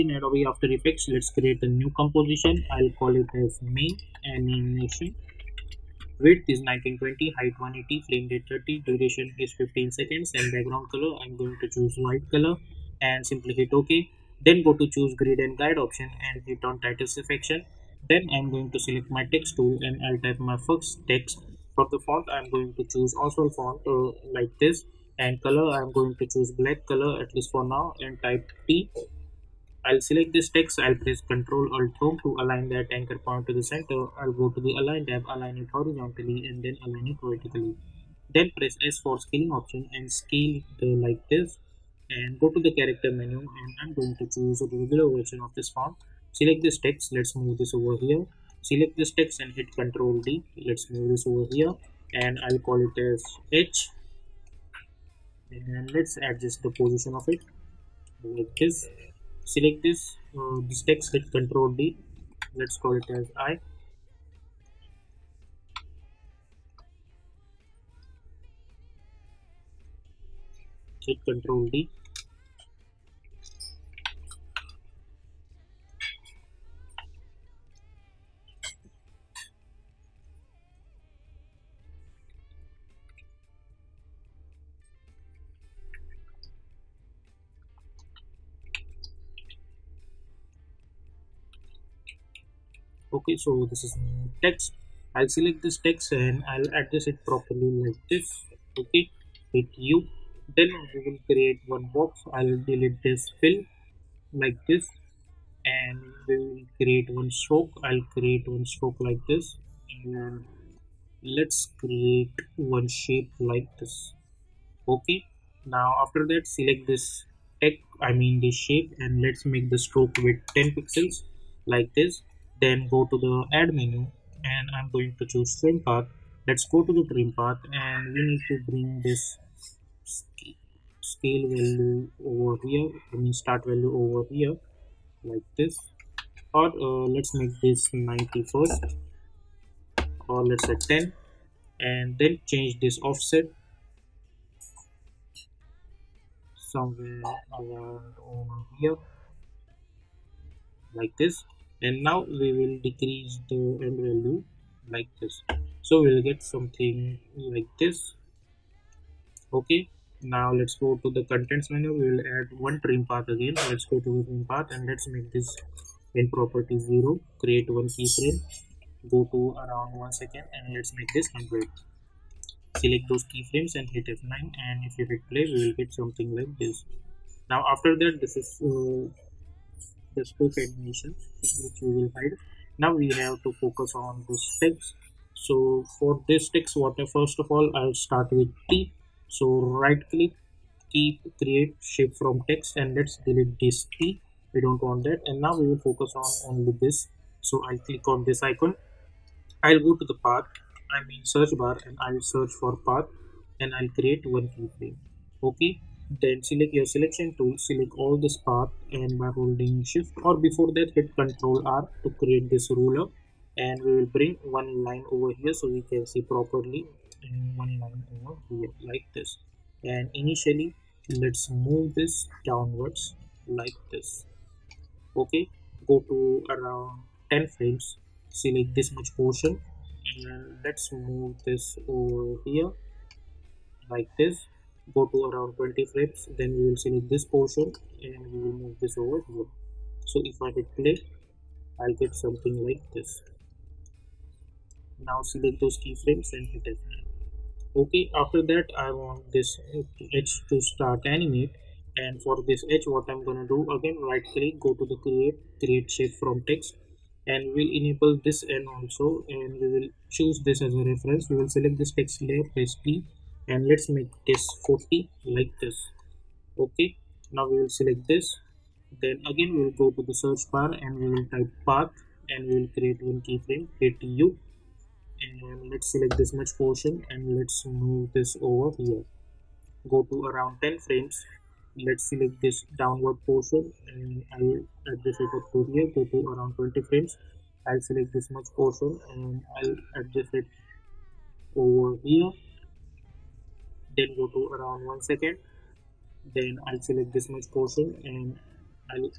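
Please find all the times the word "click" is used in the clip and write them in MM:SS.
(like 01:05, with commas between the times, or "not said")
03:10, 03:17, 04:14.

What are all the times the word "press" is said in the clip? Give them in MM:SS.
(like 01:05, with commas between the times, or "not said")
00:30, 00:38, 04:22.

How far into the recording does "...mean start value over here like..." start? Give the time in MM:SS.
02:13.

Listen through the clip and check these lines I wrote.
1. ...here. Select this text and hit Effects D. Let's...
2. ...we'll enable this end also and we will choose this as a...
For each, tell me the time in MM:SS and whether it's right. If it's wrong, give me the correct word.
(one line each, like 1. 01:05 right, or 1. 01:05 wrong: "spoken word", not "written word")
1. 00:47 wrong: "Ctrl", not "Effects"
2. 04:17 right.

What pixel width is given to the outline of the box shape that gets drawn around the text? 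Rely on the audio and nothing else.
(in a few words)
10 pixels.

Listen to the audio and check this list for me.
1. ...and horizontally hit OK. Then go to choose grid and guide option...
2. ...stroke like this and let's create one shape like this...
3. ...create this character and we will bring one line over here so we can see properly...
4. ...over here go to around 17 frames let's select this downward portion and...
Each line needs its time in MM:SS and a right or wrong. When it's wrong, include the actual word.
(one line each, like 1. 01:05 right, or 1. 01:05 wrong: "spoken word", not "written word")
1. 00:13 wrong: "simply", not "horizontally"
2. 01:48 right
3. 03:32 wrong: "ruler", not "character"
4. 04:38 wrong: "10", not "17".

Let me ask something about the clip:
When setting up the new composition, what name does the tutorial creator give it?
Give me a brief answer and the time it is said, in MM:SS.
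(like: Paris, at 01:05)
main animation, at 00:03.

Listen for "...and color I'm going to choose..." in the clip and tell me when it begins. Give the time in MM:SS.
00:25.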